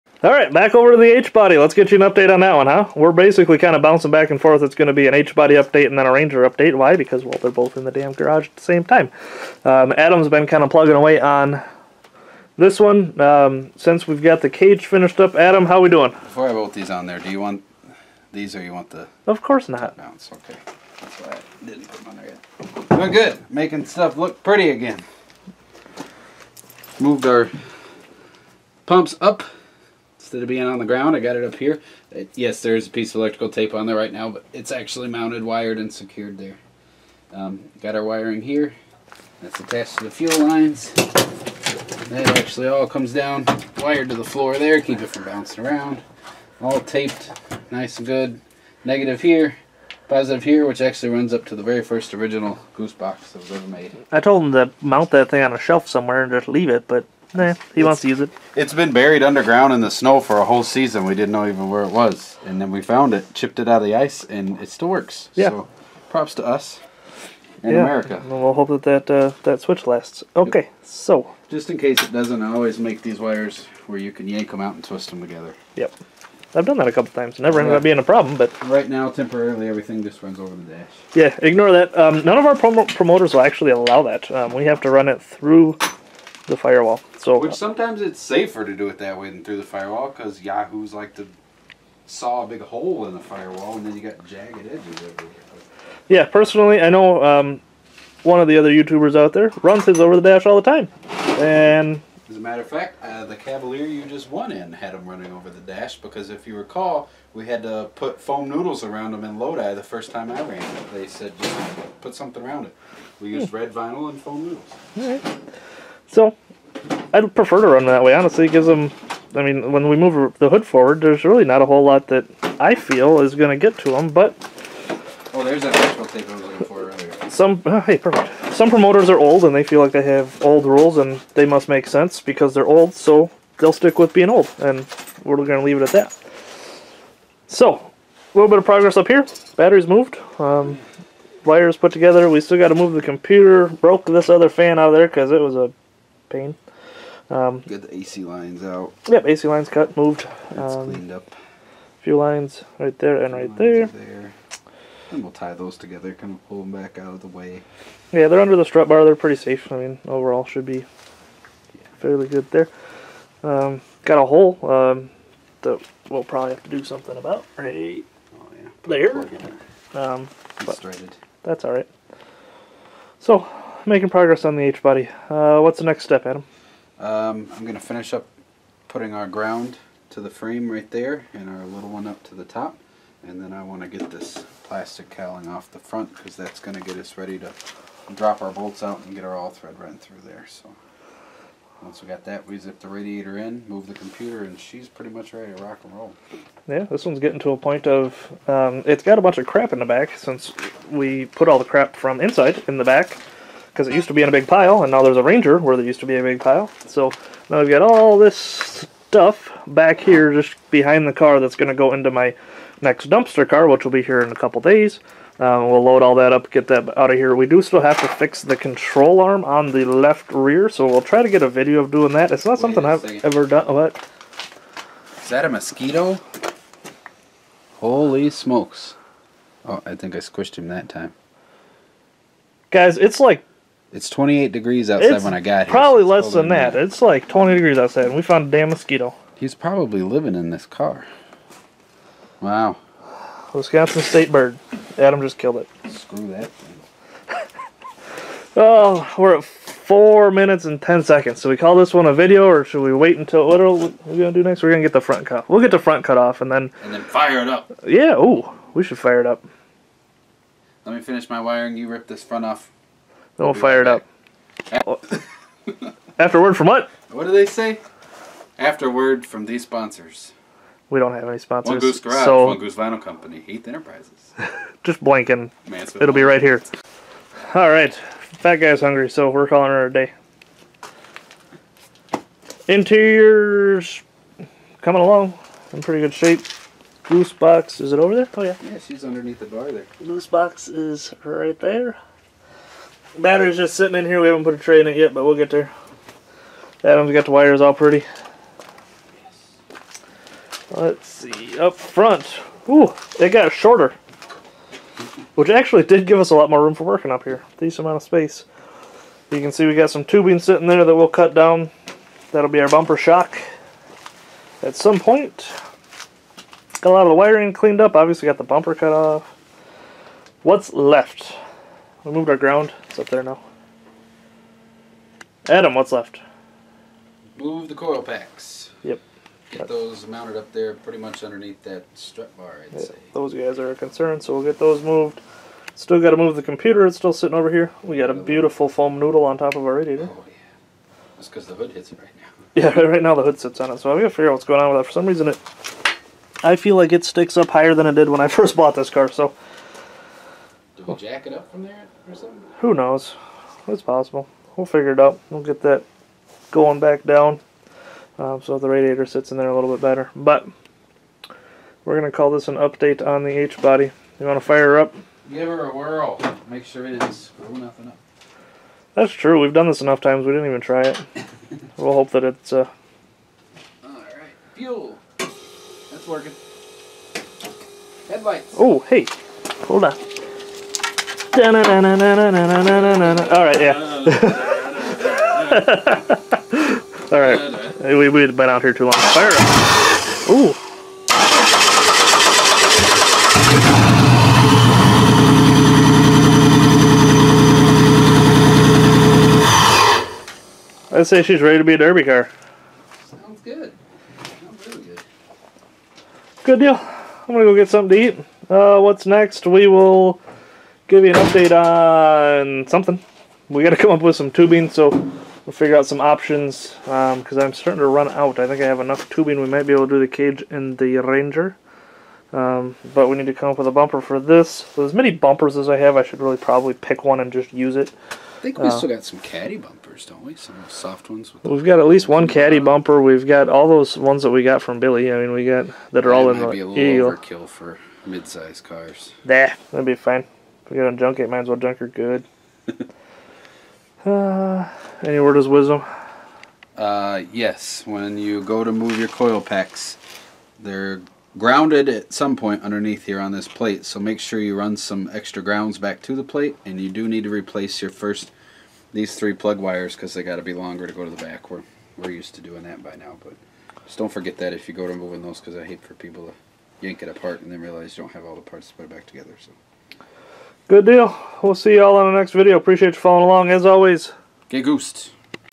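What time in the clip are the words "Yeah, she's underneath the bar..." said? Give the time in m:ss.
4:48.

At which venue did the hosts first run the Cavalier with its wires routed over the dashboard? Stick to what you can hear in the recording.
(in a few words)
Lodi.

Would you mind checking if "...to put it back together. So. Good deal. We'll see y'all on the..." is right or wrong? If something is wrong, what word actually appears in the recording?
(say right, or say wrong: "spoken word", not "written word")
right.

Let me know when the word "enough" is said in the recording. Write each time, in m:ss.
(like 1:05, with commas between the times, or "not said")
6:09, 6:58.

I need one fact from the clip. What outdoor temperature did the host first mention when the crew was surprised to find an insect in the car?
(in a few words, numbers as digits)
28 degrees.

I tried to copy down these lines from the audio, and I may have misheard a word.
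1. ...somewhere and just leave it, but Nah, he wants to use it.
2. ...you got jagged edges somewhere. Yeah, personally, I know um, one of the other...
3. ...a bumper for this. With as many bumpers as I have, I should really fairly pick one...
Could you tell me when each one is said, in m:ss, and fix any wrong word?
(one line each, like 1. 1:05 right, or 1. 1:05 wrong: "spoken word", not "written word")
1. 0:55 right
2. 1:33 wrong: "everywhere", not "somewhere"
3. 7:03 wrong: "probably", not "fairly".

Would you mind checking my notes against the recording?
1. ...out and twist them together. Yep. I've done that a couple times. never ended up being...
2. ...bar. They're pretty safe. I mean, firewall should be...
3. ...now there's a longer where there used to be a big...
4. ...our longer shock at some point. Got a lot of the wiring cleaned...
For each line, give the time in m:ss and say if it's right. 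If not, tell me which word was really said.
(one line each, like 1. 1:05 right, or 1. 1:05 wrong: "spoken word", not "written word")
1. 1:14 right
2. 2:38 wrong: "overall", not "firewall"
3. 3:24 wrong: "ranger", not "longer"
4. 5:12 wrong: "bumper", not "longer".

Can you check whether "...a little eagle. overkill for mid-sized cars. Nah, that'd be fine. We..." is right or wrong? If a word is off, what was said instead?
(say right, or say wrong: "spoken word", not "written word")
right.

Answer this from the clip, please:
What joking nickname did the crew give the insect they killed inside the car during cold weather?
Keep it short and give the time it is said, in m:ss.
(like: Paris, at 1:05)
Wisconsin state bird, at 4:03.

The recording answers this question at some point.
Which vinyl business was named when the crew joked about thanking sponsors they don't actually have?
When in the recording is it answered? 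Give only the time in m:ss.
4:32.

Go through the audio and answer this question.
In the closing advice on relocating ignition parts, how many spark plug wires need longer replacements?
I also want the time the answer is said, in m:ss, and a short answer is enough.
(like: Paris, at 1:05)
3, at 7:39.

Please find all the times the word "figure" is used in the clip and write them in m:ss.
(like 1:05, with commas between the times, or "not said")
5:44, 5:54, 6:55.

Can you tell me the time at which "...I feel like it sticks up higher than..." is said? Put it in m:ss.
5:46.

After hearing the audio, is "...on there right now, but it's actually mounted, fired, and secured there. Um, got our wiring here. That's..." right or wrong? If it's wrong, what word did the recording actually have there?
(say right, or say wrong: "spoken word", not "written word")
wrong: "wired", not "fired".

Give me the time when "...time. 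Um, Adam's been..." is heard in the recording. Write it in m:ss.
0:08.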